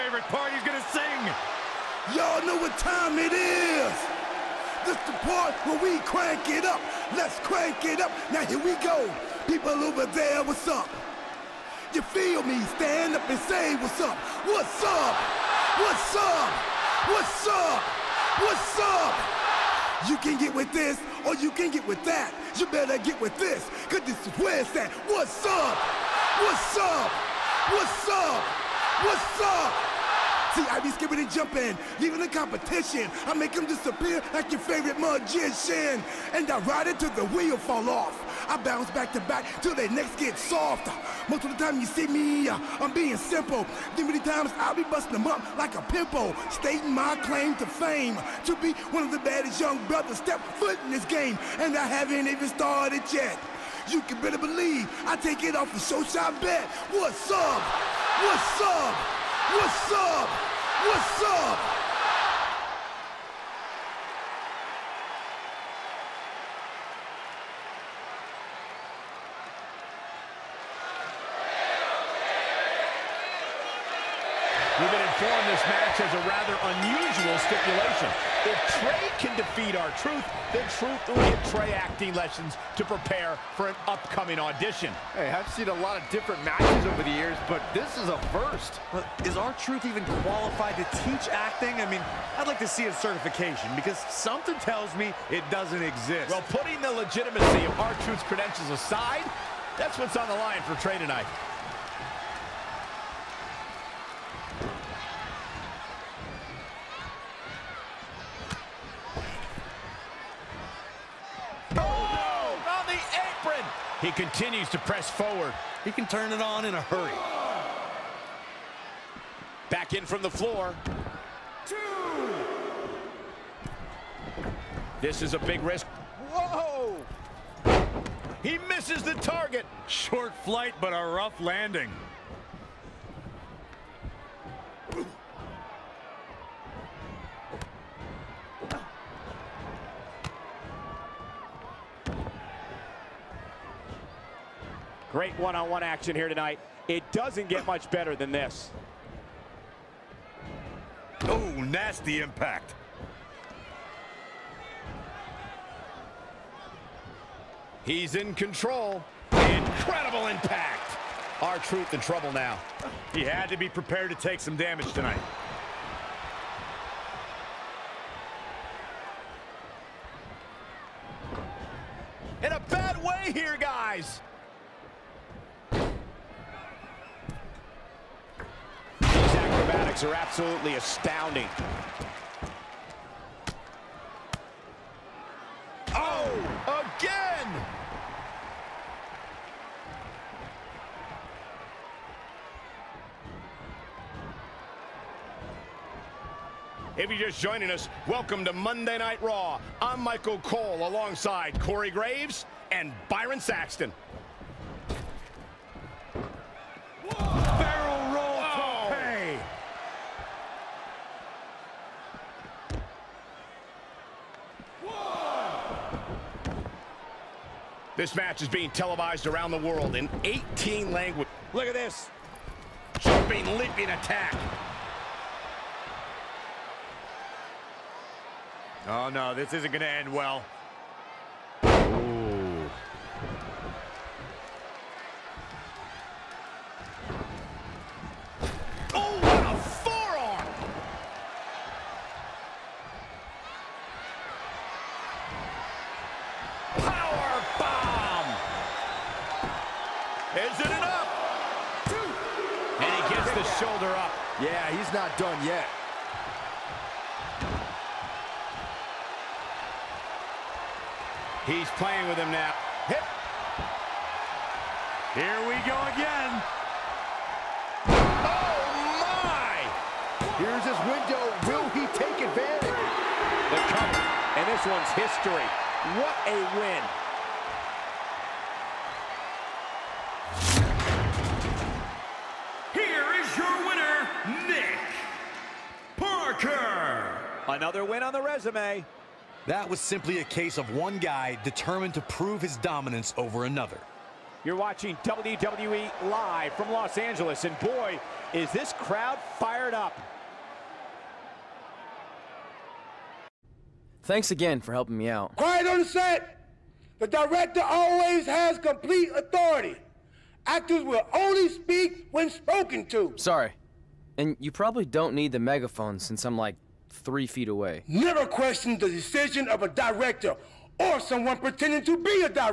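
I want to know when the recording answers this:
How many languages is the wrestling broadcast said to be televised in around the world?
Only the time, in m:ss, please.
3:40.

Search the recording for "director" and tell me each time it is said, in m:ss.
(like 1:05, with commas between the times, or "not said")
5:07, 5:19.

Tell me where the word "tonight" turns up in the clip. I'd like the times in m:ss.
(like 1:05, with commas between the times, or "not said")
1:40, 2:26, 2:44.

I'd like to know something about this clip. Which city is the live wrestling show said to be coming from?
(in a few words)
Los Angeles.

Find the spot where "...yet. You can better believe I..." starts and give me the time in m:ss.
0:53.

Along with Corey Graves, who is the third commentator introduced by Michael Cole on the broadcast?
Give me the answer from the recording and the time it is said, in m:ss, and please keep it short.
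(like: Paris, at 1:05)
Byron Saxton, at 3:23.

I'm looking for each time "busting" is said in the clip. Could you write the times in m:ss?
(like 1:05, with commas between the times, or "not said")
0:44.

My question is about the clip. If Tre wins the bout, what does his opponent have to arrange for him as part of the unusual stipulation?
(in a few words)
Acting lessons.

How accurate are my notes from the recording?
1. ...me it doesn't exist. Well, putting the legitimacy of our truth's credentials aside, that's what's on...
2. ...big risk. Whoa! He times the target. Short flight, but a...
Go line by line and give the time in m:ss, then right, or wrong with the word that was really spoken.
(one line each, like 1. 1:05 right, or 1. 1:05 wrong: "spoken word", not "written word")
1. 1:34 right
2. 2:05 wrong: "misses", not "times".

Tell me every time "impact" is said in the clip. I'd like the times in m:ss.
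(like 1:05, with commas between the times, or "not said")
2:32, 2:40.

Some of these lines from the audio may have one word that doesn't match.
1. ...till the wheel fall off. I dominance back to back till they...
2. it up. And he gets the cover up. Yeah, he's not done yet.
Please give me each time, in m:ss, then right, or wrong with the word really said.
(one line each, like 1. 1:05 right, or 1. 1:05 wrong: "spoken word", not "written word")
1. 0:36 wrong: "bounce", not "dominance"
2. 4:10 wrong: "shoulder", not "cover".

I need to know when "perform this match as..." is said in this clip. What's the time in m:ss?
1:15.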